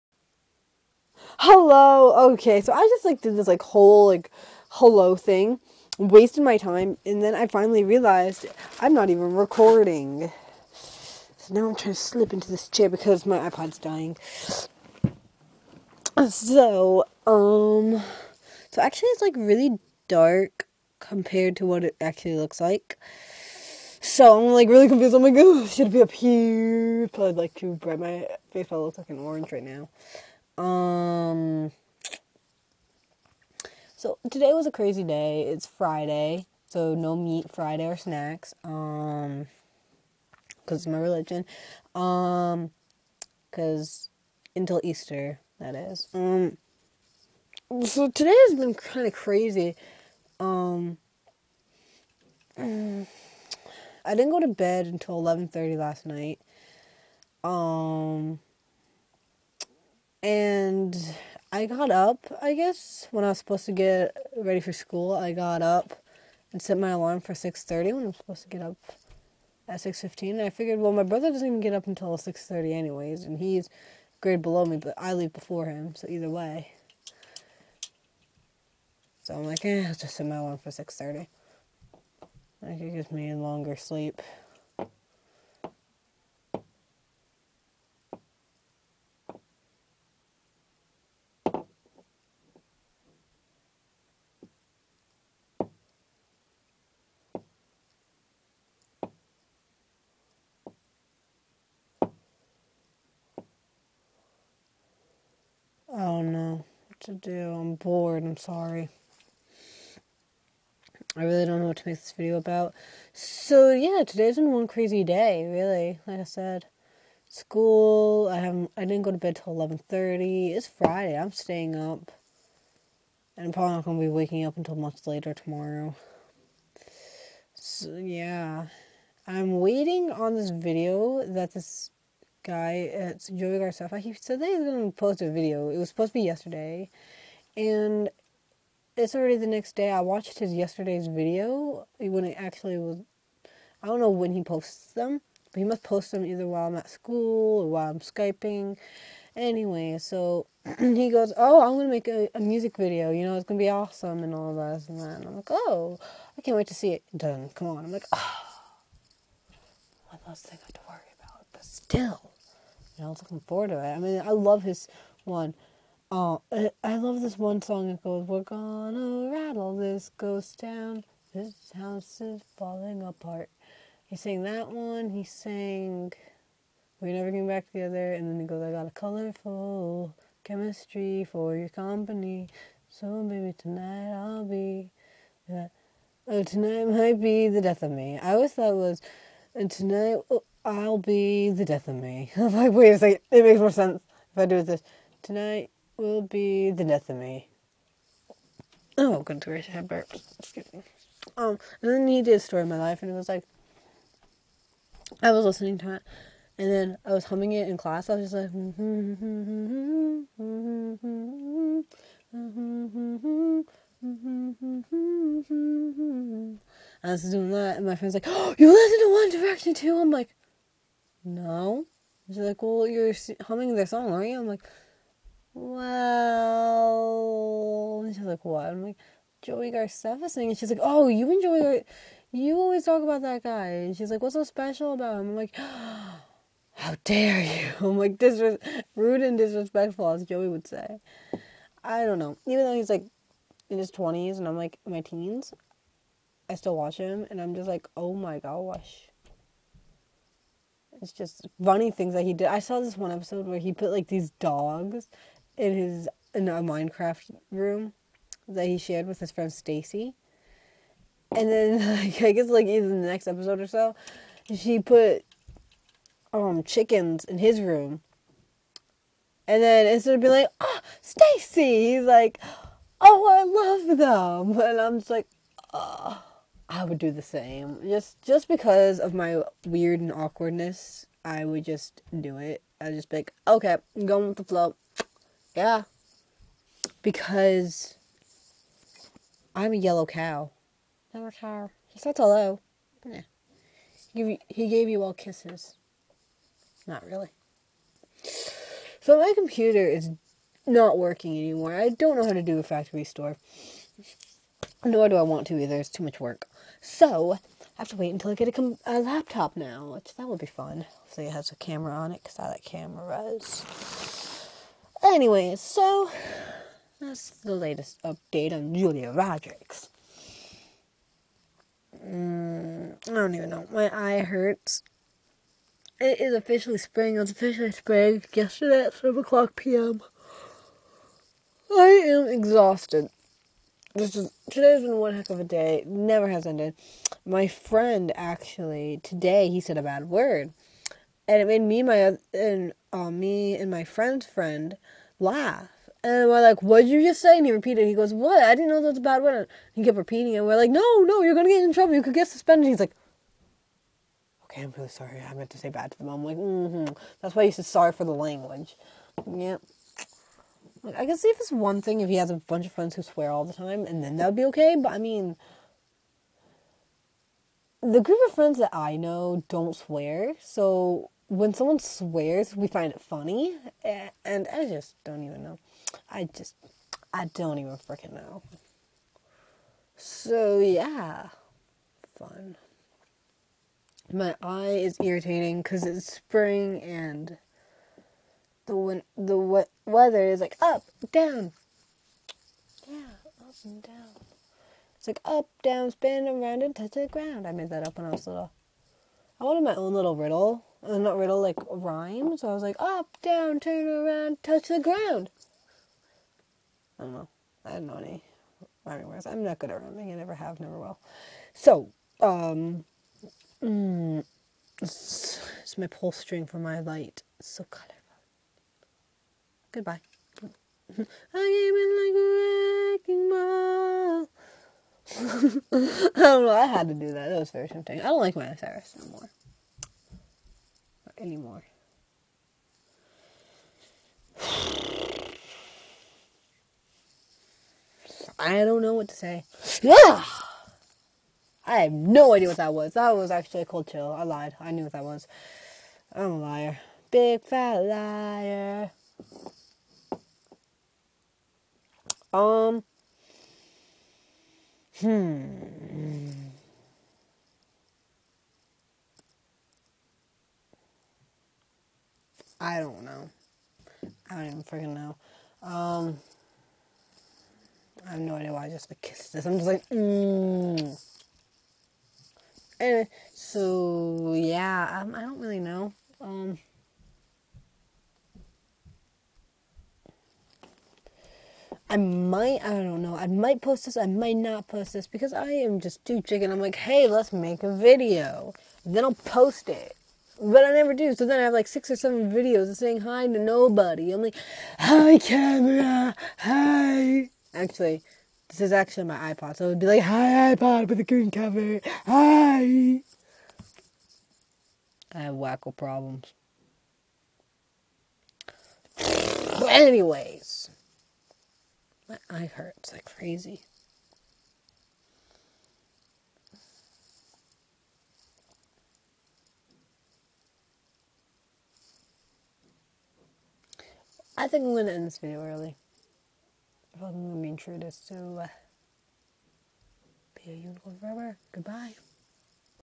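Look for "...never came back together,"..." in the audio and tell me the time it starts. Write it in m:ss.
2:57.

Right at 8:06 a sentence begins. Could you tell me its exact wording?
I'm like, hey, let's make a video.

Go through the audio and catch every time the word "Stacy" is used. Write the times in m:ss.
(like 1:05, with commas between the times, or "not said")
4:19, 4:31.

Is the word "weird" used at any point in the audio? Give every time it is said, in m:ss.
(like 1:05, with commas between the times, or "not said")
4:39.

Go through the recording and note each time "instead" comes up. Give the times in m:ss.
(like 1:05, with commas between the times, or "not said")
4:29.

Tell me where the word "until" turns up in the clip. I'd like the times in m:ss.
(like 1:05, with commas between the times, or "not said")
0:44, 0:54, 1:11, 2:04, 5:08.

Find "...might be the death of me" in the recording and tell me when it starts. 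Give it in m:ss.
3:06.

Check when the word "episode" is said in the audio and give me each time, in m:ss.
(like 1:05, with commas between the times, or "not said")
4:13, 4:23.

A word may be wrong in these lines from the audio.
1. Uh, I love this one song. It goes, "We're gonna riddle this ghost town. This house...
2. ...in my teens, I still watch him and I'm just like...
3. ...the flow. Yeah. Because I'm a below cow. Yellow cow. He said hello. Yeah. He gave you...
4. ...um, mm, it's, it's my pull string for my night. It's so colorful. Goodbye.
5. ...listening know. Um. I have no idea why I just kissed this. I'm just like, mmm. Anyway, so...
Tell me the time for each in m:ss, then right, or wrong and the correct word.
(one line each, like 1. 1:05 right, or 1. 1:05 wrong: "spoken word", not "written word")
1. 2:46 wrong: "rattle", not "riddle"
2. 4:04 right
3. 4:44 wrong: "yellow", not "below"
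4. 6:52 wrong: "light", not "night"
5. 7:44 wrong: "freaking", not "listening".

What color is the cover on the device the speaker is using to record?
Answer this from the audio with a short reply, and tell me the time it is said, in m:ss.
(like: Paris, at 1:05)
green, at 8:21.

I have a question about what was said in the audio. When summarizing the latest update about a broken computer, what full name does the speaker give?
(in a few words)
Julia Rogers.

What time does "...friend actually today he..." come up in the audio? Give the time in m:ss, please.
5:37.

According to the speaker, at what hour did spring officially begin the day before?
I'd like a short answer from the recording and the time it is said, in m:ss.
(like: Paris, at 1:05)
7 p.m., at 5:28.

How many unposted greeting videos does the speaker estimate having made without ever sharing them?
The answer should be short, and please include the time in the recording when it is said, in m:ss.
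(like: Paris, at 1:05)
6 or 7, at 8:11.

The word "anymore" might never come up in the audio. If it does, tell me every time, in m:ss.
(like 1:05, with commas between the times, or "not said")
5:01, 7:11.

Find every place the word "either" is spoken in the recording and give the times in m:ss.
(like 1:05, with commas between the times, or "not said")
1:16, 2:26, 4:22, 5:05.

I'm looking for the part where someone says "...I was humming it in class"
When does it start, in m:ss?
3:27.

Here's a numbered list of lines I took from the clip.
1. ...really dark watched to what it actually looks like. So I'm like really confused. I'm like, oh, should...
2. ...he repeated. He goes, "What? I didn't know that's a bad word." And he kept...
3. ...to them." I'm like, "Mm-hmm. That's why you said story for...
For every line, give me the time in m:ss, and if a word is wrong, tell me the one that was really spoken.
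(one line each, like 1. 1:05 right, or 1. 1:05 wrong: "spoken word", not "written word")
1. 0:19 wrong: "compared", not "watched"
2. 5:47 right
3. 5:55 wrong: "sorry", not "story".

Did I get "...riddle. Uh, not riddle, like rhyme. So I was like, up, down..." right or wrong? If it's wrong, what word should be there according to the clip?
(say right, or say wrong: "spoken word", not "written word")
right.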